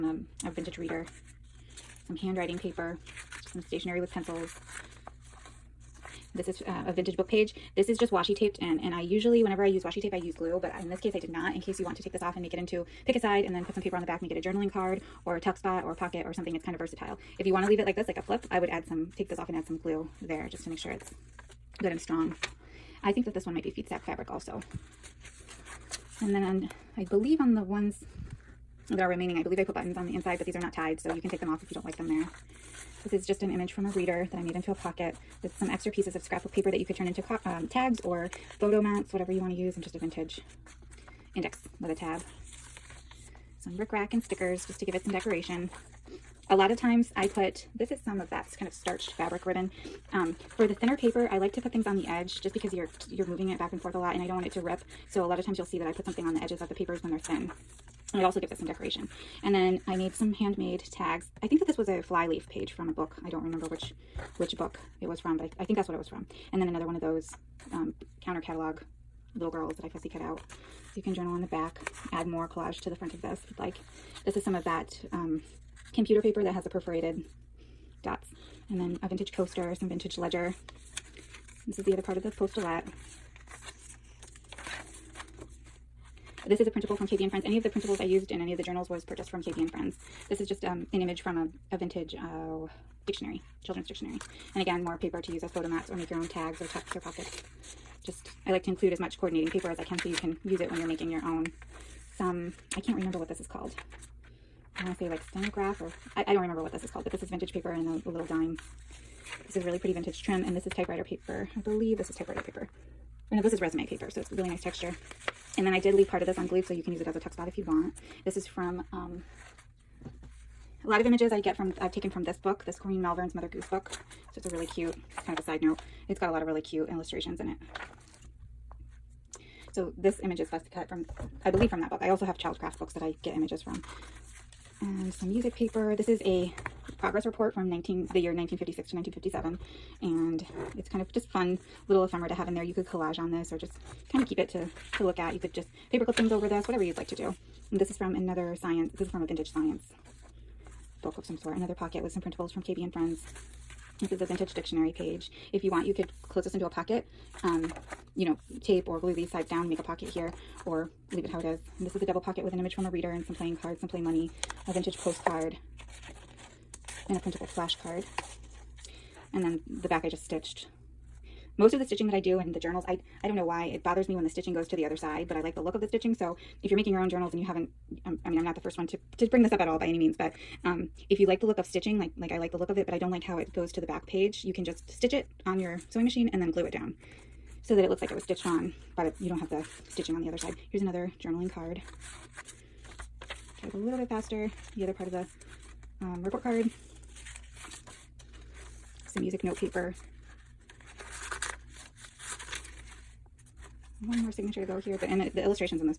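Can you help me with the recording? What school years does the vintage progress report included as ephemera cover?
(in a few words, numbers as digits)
1956 to 1957.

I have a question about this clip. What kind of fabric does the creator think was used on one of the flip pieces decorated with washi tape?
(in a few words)
Feed sack fabric.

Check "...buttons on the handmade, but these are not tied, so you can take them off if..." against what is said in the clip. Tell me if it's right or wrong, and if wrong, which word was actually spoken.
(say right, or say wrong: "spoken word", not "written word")
wrong: "inside", not "handmade".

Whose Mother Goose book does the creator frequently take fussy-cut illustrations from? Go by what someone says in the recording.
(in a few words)
Corinne Malvern.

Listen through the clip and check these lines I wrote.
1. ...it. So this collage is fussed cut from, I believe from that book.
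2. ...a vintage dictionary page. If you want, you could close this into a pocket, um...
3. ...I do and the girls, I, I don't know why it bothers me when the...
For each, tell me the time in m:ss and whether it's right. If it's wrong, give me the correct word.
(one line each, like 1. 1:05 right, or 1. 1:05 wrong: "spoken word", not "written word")
1. 2:07 wrong: "image", not "collage"
2. 2:34 right
3. 2:52 wrong: "journals", not "girls".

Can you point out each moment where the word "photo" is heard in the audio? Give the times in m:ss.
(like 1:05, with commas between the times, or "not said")
0:38, 1:35.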